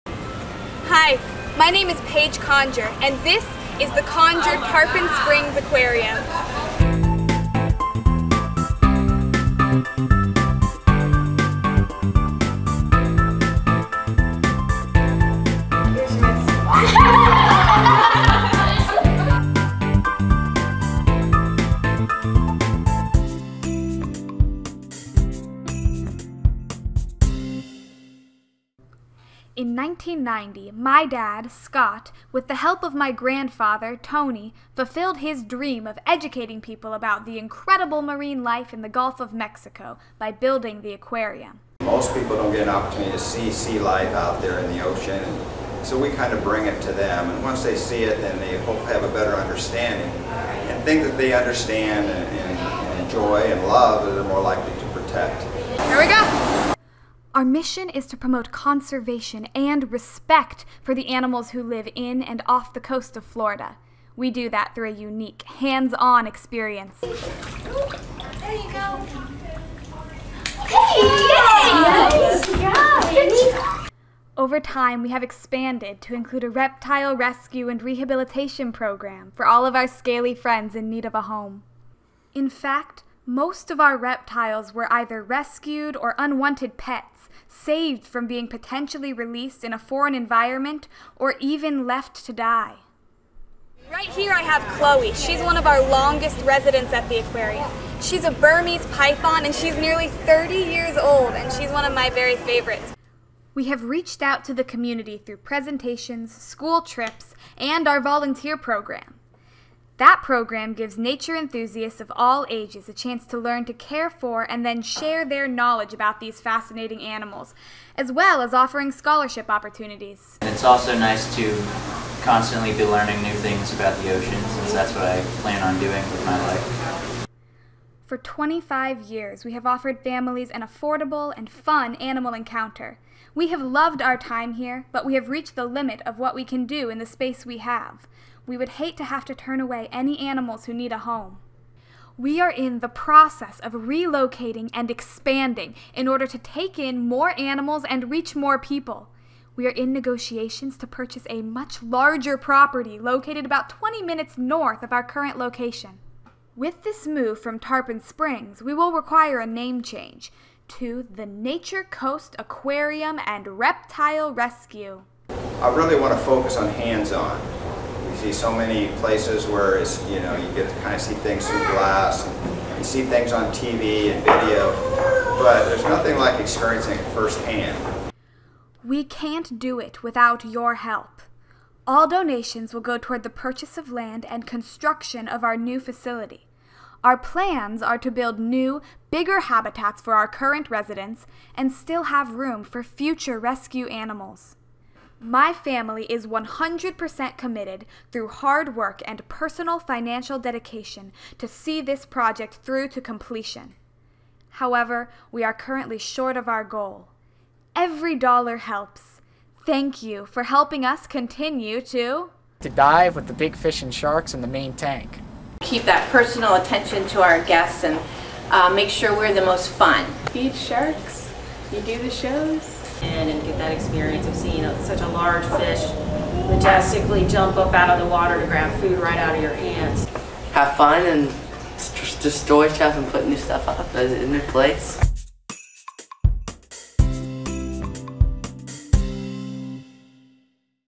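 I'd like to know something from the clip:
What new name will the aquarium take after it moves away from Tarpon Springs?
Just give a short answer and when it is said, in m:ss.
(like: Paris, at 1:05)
Nature Coast Aquarium and Reptile Rescue, at 2:41.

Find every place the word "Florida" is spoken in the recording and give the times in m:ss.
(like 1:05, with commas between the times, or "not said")
1:03.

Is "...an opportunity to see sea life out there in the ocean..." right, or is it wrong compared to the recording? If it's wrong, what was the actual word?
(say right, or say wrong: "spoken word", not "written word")
right.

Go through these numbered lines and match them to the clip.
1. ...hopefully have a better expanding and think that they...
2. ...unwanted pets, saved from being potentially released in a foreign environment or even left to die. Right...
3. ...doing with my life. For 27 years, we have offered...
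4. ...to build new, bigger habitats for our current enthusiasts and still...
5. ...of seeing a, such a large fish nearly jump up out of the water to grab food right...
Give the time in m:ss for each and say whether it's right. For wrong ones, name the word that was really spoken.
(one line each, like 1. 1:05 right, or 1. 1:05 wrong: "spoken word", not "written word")
1. 0:48 wrong: "understanding", not "expanding"
2. 1:26 right
3. 2:05 wrong: "25", not "27"
4. 3:07 wrong: "residents", not "enthusiasts"
5. 3:44 wrong: "majestically", not "nearly".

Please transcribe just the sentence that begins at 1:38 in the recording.
She's a Burmese python and she's nearly 30 years old and she's one of my very favorites.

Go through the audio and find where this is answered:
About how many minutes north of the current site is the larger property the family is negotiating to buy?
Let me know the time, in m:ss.
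2:33.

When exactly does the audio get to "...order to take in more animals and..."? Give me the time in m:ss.
2:26.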